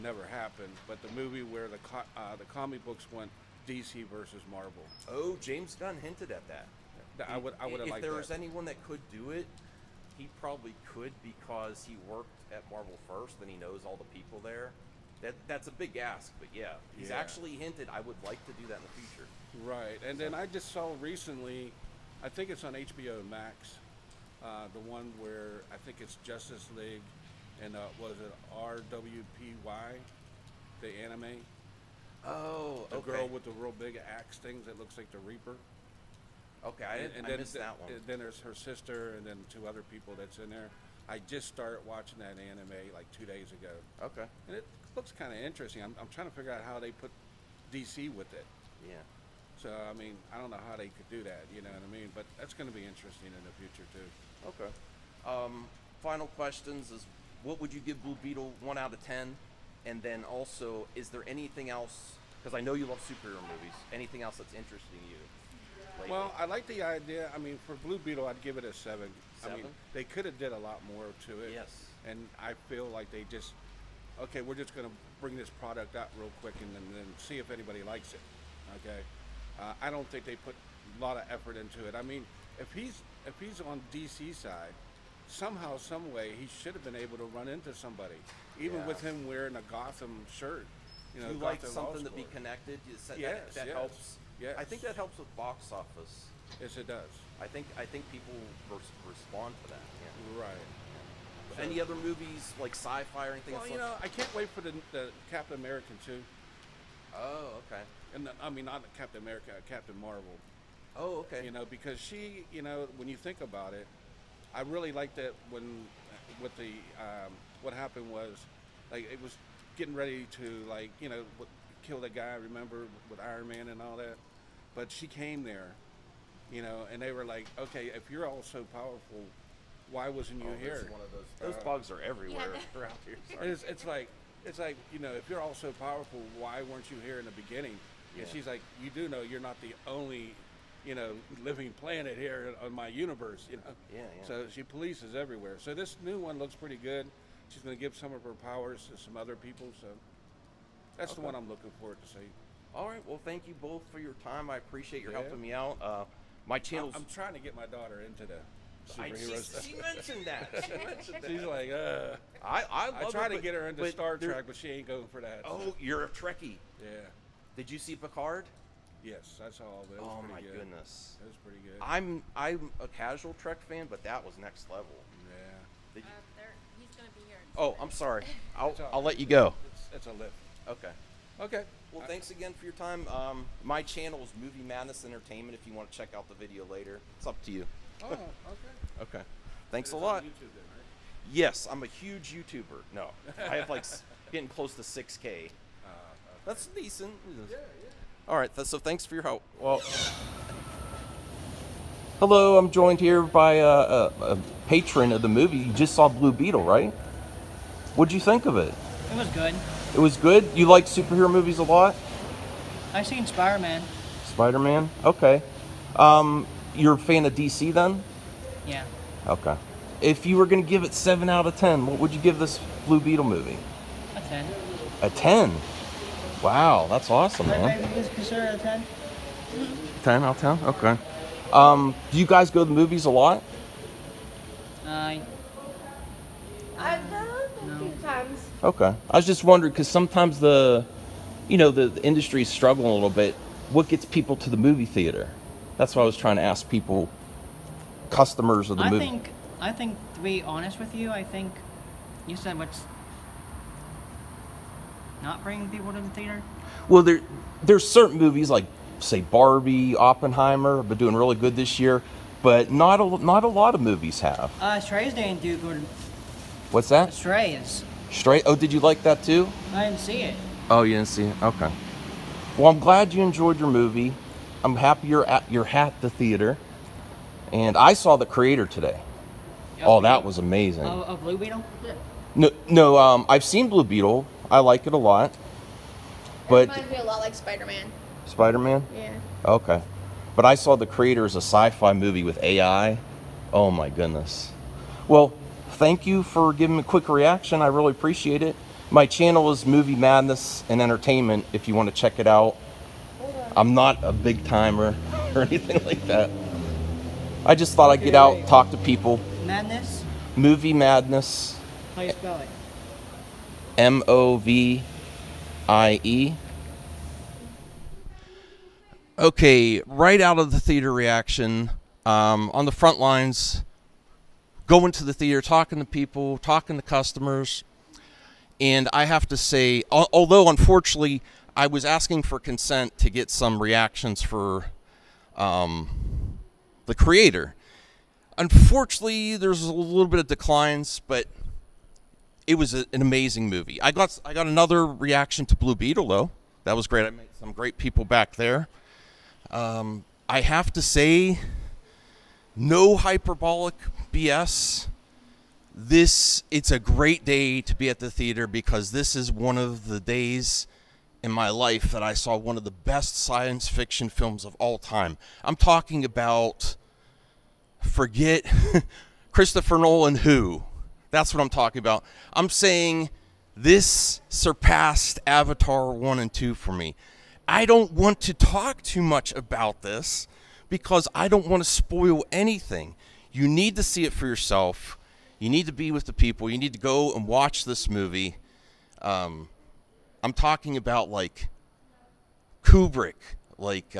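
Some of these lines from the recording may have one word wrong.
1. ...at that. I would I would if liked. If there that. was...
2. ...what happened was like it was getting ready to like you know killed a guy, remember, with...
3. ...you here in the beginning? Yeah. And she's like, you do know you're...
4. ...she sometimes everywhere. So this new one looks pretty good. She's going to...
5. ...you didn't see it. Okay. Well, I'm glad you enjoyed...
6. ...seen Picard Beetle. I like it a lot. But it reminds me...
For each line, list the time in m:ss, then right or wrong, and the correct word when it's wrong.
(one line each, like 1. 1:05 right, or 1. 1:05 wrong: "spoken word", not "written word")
1. 0:06 right
2. 1:57 right
3. 2:16 right
4. 2:24 wrong: "polices", not "sometimes"
5. 4:30 right
6. 4:43 wrong: "Blue", not "Picard".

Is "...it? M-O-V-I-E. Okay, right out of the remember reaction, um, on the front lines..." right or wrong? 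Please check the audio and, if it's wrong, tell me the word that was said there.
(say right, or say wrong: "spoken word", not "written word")
wrong: "theater", not "remember".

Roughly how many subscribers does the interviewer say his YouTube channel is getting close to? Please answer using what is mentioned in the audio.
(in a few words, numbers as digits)
6K.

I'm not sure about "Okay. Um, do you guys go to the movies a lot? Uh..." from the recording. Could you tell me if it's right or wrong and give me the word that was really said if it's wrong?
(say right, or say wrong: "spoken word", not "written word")
right.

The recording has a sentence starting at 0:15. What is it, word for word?
That that's a big ask, but yeah, he's yeah.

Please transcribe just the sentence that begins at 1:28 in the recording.
with him wearing a Gotham shirt.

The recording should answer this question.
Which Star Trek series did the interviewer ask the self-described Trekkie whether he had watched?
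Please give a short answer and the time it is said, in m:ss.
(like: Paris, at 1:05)
Picard, at 2:47.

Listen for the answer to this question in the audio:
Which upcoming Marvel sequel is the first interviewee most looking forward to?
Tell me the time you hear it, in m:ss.
1:49.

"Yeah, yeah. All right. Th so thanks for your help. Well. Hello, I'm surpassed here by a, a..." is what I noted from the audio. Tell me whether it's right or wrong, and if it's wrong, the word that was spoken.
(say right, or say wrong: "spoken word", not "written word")
wrong: "joined", not "surpassed".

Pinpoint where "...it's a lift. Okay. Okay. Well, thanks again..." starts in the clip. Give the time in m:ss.
2:59.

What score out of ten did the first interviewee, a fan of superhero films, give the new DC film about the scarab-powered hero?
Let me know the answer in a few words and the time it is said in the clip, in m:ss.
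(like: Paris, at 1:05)
7, at 1:08.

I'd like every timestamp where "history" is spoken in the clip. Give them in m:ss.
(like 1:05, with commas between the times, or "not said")
not said.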